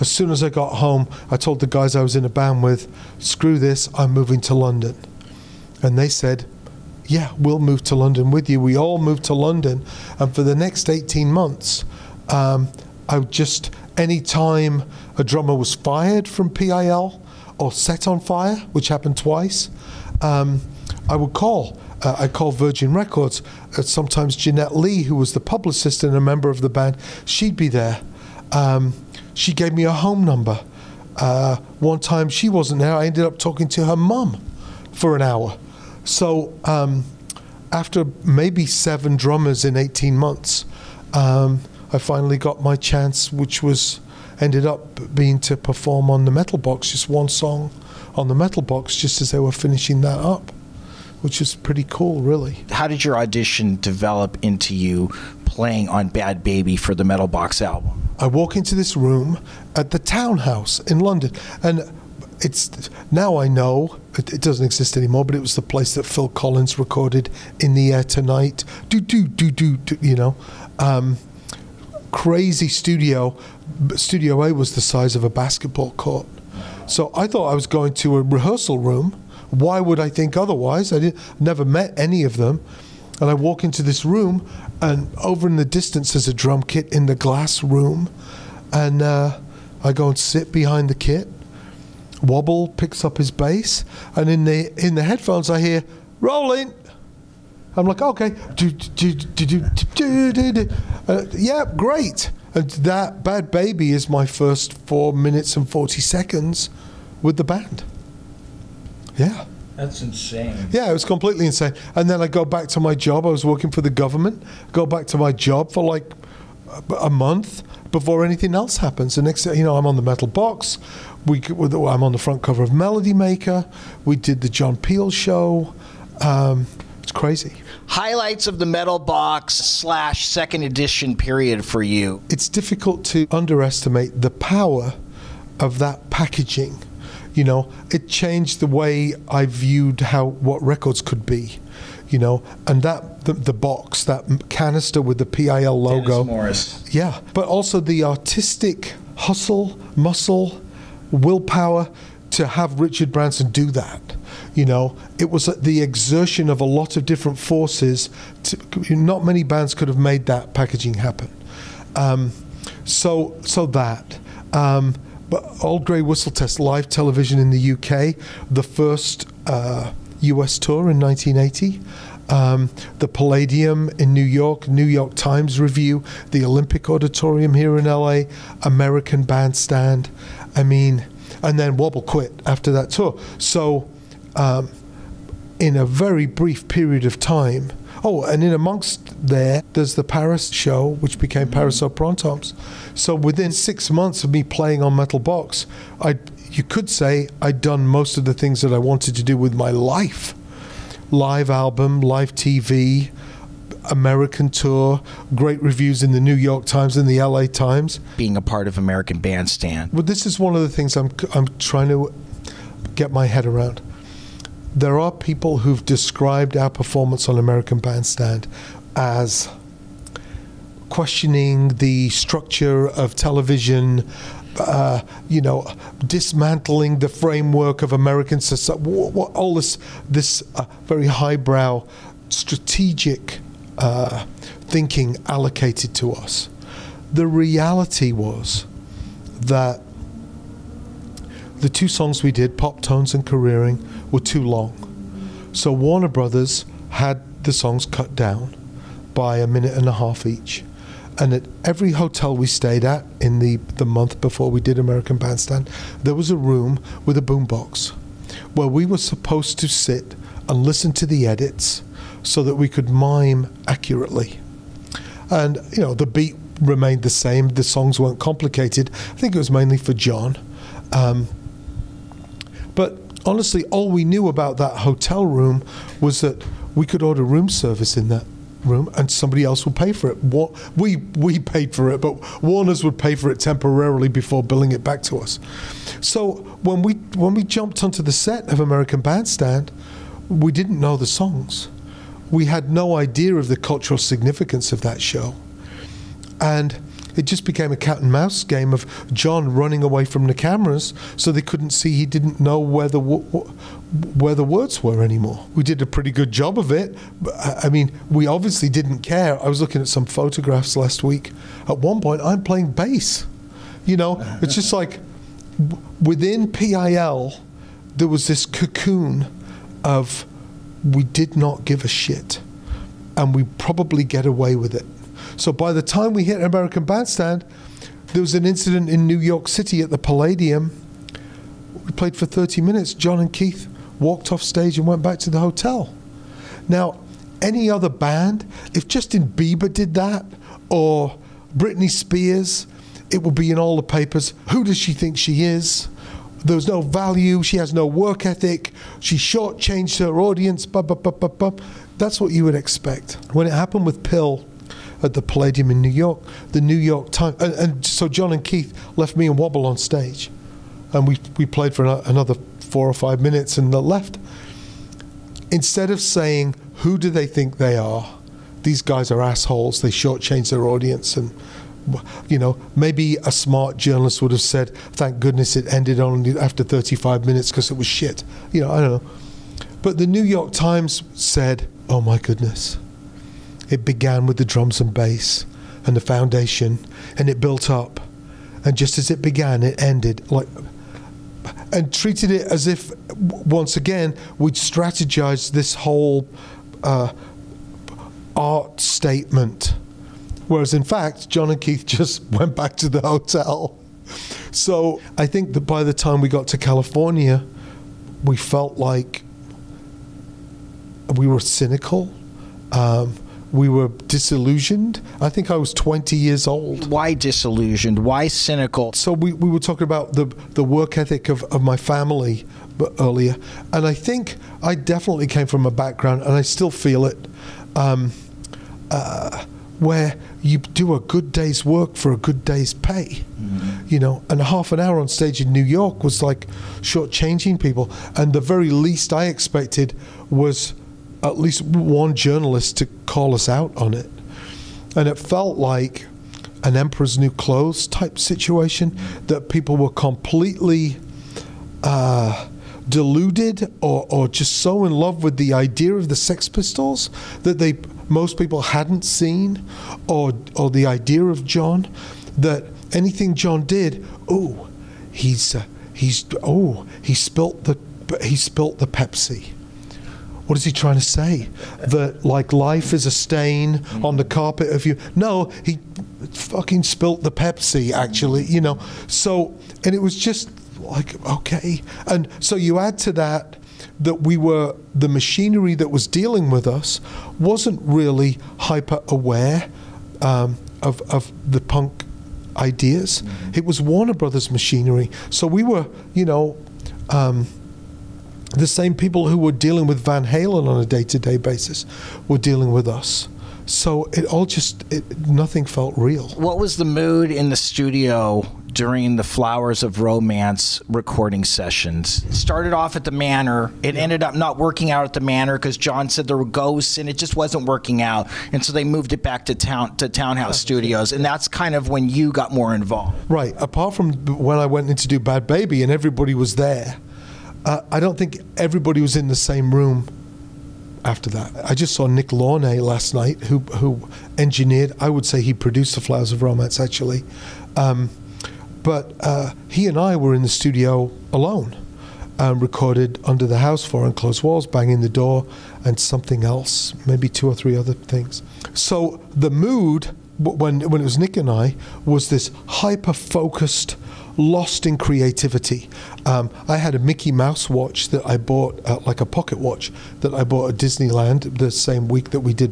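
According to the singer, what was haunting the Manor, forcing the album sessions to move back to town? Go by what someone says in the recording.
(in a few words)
ghosts.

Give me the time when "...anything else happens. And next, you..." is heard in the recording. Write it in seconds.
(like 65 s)
118 s.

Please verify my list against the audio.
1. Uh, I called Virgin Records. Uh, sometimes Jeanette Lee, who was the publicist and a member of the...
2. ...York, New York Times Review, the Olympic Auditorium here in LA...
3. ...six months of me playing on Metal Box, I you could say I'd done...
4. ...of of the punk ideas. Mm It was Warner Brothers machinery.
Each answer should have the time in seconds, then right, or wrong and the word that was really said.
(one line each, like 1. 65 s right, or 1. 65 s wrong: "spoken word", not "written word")
1. 22 s right
2. 174 s right
3. 193 s right
4. 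490 s right.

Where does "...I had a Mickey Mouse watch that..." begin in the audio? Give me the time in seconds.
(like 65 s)
556 s.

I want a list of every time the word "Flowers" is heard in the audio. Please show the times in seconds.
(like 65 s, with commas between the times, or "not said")
509 s, 536 s.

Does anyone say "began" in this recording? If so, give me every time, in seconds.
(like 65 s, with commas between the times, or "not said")
383 s, 389 s.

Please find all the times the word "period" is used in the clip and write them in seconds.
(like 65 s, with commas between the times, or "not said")
131 s, 186 s.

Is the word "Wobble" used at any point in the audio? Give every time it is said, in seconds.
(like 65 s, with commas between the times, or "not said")
92 s, 181 s, 359 s.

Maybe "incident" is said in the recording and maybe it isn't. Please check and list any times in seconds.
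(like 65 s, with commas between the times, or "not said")
328 s.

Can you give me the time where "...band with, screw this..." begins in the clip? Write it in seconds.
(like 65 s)
2 s.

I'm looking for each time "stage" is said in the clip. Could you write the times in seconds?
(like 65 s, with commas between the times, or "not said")
334 s, 359 s, 435 s.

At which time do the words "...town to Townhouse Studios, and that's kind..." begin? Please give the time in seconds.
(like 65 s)
519 s.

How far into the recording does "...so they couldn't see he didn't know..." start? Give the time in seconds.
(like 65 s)
301 s.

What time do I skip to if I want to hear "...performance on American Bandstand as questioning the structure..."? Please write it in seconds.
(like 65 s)
216 s.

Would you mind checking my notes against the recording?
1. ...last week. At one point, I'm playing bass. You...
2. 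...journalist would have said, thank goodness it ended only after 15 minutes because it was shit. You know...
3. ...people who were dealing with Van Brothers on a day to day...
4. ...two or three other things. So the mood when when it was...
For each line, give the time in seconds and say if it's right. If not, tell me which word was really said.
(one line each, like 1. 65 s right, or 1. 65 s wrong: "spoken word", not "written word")
1. 310 s right
2. 373 s wrong: "35", not "15"
3. 498 s wrong: "Halen", not "Brothers"
4. 547 s right.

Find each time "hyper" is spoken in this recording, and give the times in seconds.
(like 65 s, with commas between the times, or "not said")
488 s, 552 s.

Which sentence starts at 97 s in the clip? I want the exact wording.
I'm like, okay, Uh, yeah, great.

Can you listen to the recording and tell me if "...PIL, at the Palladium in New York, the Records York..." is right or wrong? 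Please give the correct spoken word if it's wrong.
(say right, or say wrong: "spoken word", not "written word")
wrong: "New", not "Records".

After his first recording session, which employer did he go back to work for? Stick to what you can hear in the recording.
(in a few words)
the government.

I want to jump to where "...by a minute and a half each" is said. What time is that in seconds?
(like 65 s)
249 s.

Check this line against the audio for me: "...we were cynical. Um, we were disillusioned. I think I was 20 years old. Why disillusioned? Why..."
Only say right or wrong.
right.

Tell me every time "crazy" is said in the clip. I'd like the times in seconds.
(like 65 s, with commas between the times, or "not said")
72 s, 127 s.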